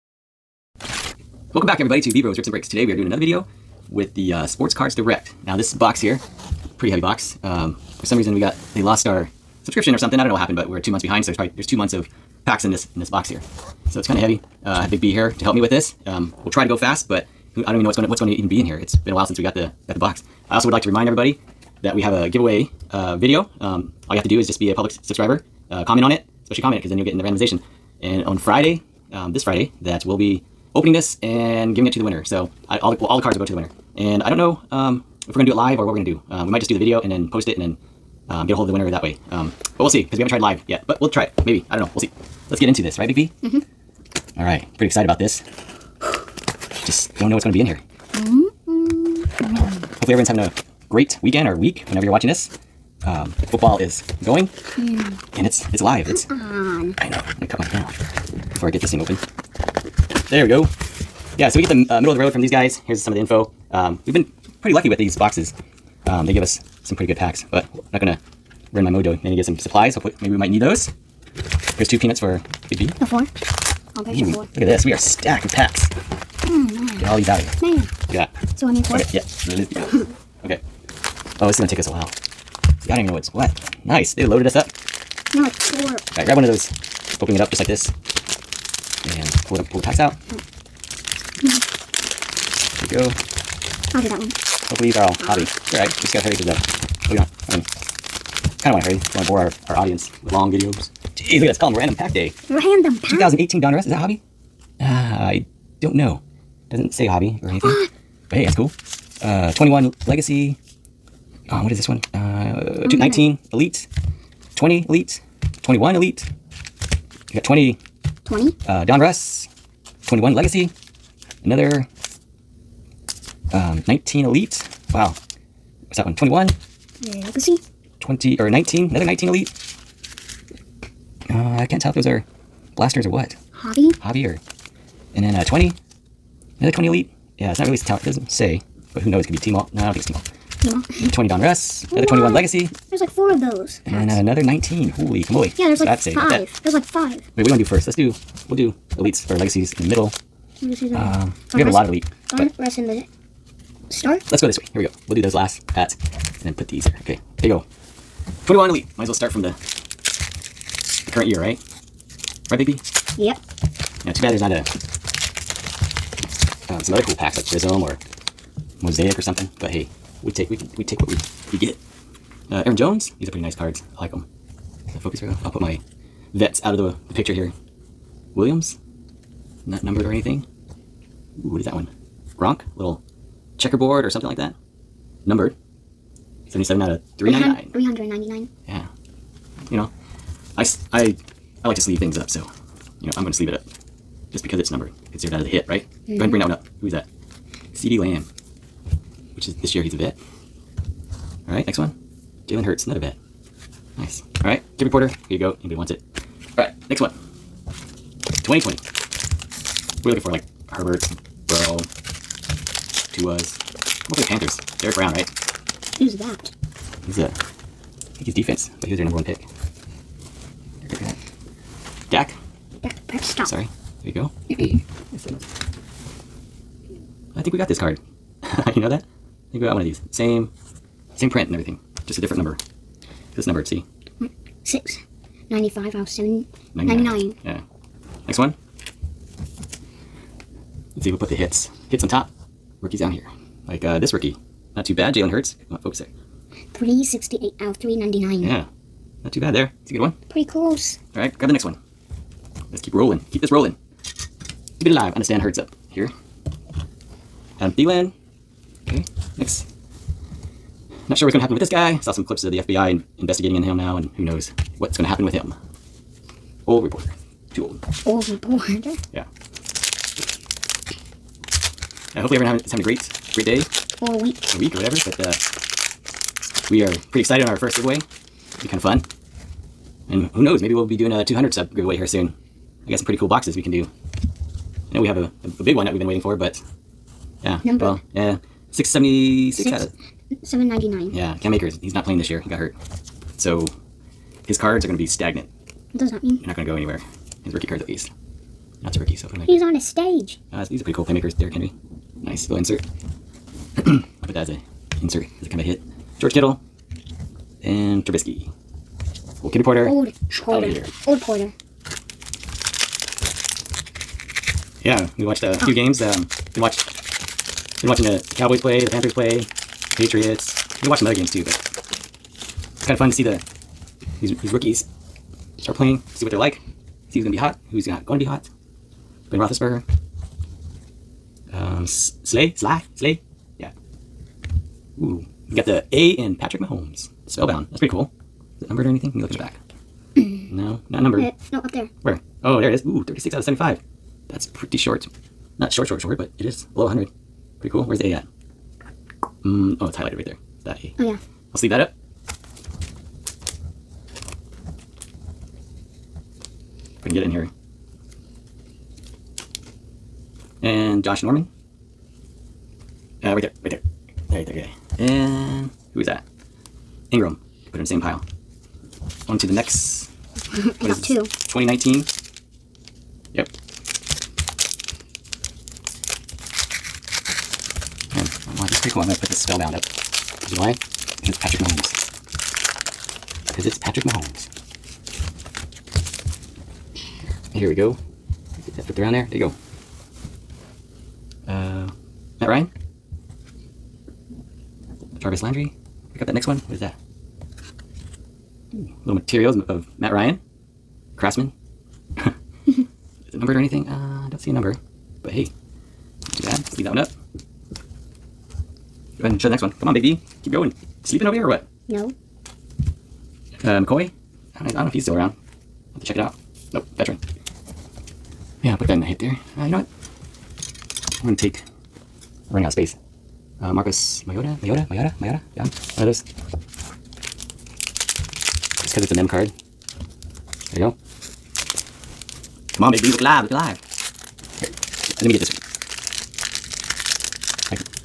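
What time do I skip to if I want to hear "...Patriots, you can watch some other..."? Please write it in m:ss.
5:19.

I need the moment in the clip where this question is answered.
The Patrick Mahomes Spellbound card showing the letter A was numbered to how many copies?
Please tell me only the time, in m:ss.
5:43.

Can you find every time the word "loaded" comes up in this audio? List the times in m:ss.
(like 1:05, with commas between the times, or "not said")
1:24.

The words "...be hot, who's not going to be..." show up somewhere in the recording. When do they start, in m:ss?
5:27.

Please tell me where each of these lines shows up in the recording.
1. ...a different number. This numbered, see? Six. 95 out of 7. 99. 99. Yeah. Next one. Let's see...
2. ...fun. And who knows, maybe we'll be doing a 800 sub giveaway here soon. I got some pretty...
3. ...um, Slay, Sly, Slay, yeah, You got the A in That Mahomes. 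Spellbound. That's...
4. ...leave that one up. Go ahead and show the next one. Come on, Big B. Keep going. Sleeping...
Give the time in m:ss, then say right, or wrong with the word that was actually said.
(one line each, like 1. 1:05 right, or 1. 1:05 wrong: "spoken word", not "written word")
1. 3:52 right
2. 4:38 wrong: "200", not "800"
3. 5:31 wrong: "Patrick", not "That"
4. 6:46 right.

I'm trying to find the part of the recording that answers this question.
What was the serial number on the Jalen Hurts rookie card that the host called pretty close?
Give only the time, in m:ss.
4:06.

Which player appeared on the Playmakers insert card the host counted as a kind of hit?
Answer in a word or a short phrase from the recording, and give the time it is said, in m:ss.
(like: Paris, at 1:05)
Derrick Henry, at 5:01.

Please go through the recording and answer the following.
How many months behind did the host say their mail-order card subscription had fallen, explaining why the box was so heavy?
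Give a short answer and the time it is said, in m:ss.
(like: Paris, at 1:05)
2, at 0:10.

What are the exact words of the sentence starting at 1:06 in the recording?
Um, they give us some pretty good packs, but I'm not gonna ruin my mojo.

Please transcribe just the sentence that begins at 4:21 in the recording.
Not sure what's going to happen with this guy.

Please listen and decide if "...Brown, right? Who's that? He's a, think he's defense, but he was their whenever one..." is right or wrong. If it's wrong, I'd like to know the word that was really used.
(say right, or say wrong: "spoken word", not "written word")
wrong: "number", not "whenever".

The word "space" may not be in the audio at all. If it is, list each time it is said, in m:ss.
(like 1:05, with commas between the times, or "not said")
7:02.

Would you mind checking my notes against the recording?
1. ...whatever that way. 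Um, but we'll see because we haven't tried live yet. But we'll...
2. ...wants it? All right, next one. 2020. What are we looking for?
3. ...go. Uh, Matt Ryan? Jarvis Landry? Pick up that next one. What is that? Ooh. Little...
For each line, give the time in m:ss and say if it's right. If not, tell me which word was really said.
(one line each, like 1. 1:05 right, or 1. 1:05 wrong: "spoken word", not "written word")
1. 0:38 wrong: "winner", not "whatever"
2. 3:25 right
3. 6:31 right.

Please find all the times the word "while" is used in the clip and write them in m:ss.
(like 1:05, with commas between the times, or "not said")
0:19, 1:21.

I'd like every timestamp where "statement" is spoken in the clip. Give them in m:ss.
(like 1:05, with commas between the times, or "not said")
not said.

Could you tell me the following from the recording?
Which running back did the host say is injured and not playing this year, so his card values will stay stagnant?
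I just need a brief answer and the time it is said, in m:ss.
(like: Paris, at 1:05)
Cam Akers, at 4:51.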